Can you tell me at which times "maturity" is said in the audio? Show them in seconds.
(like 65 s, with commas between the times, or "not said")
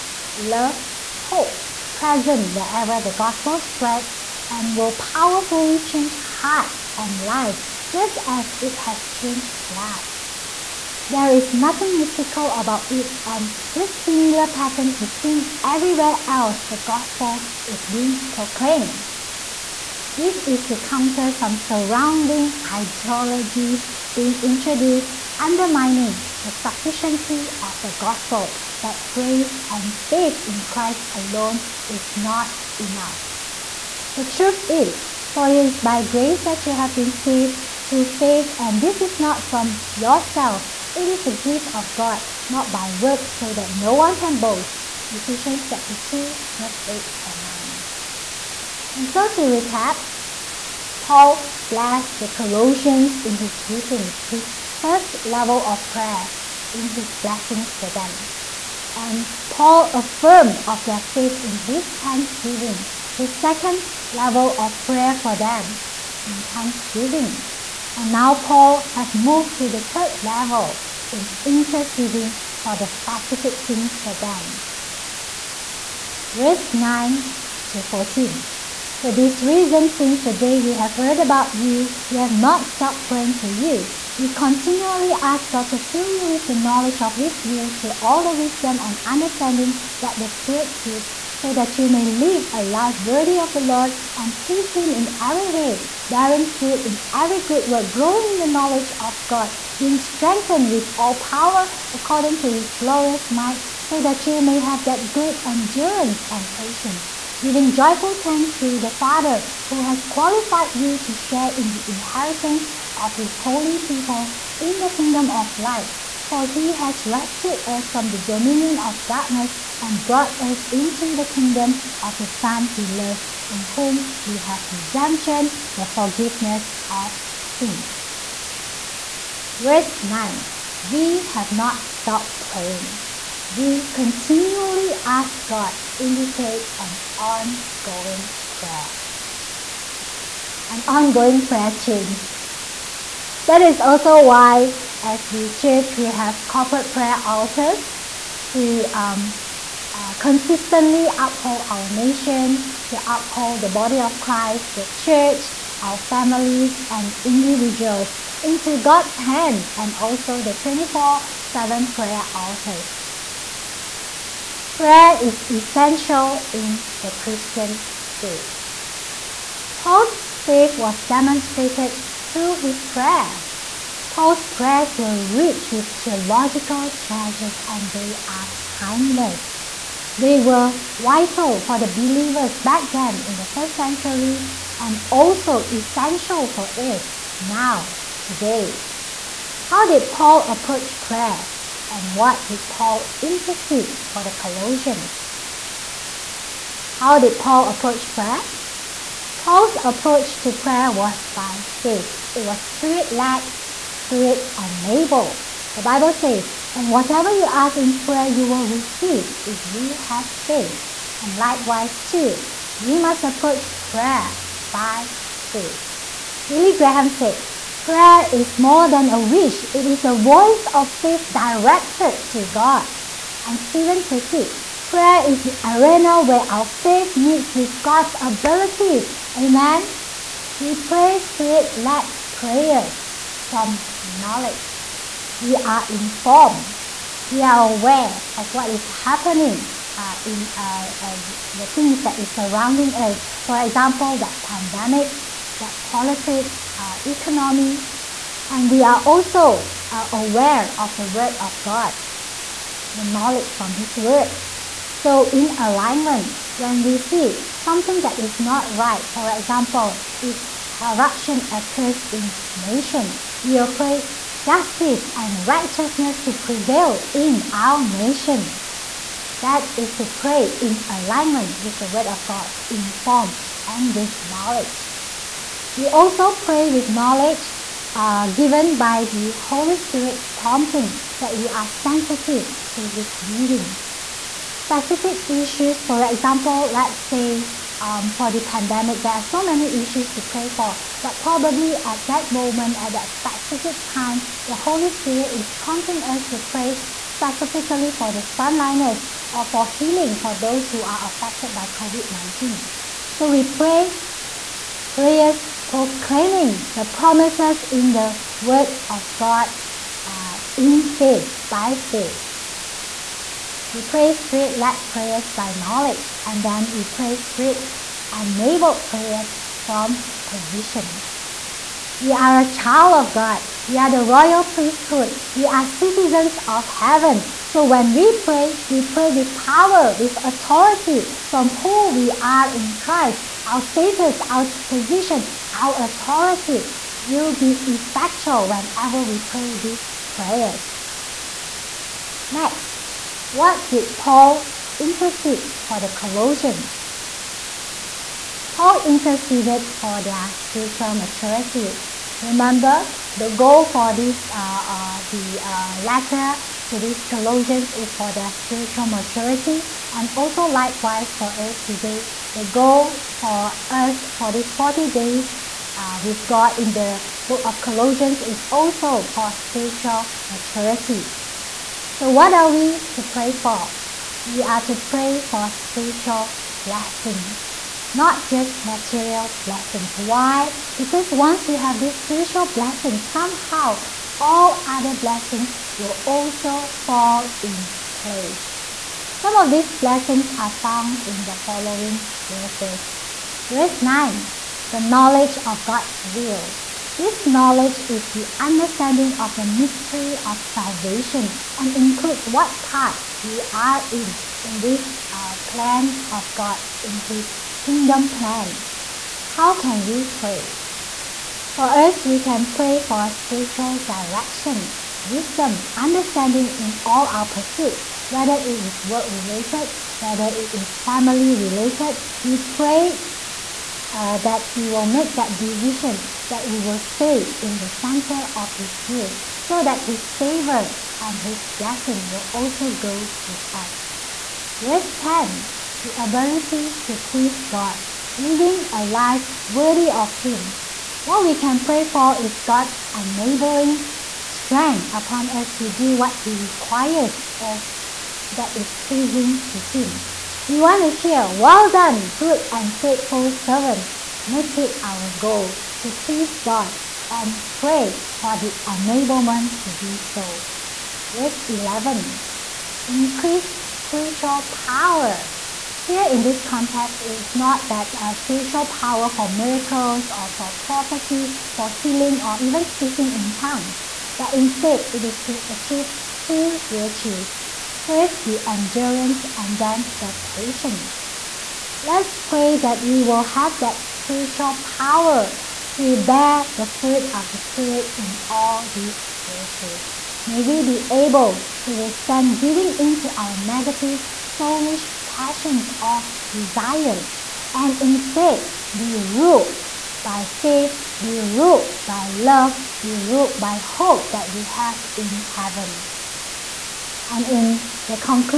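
350 s, 358 s, 370 s.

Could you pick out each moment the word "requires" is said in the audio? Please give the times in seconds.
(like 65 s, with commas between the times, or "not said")
446 s.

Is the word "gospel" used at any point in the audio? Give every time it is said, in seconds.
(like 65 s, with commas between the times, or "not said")
3 s, 16 s, 27 s.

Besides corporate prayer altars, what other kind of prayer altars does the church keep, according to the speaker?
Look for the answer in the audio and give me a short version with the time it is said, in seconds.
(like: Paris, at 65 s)
24/7 prayer altars, at 160 s.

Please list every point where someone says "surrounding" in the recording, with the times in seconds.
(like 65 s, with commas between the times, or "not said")
21 s, 242 s.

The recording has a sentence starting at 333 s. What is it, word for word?
Our status, our position, our authority will be effectual whenever we pray these prayers.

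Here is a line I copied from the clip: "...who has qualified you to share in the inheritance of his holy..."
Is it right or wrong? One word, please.
right.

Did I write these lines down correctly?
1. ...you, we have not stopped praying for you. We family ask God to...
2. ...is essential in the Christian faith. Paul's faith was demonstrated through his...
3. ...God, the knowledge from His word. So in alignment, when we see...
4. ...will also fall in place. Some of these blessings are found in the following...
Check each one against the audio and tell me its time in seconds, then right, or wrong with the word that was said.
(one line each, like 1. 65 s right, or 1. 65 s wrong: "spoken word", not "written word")
1. 81 s wrong: "continually", not "family"
2. 165 s right
3. 251 s right
4. 385 s right.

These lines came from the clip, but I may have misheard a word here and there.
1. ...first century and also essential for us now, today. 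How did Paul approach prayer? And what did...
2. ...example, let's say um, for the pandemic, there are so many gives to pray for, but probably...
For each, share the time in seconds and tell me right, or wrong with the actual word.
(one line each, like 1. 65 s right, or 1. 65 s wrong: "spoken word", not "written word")
1. 183 s right
2. 286 s wrong: "issues", not "gives".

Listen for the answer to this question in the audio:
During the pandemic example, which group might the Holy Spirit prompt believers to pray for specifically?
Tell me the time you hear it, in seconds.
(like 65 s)
298 s.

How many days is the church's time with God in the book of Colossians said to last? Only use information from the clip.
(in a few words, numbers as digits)
40.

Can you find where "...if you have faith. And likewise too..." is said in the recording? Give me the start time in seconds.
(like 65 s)
209 s.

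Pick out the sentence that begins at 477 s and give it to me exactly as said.
First, the endurance and then the patience.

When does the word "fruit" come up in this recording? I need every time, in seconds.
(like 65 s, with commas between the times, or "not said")
96 s, 486 s.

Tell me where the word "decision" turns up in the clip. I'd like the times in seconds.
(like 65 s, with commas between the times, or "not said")
425 s.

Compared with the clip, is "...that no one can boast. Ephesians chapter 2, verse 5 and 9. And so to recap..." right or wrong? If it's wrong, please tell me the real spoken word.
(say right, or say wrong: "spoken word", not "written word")
wrong: "8", not "5".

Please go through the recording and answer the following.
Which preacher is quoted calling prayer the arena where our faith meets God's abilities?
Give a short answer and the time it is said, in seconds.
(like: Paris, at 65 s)
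Steven Furtick, at 223 s.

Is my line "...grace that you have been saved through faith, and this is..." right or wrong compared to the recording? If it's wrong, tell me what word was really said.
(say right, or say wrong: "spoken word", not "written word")
right.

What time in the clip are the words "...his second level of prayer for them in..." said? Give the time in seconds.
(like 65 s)
63 s.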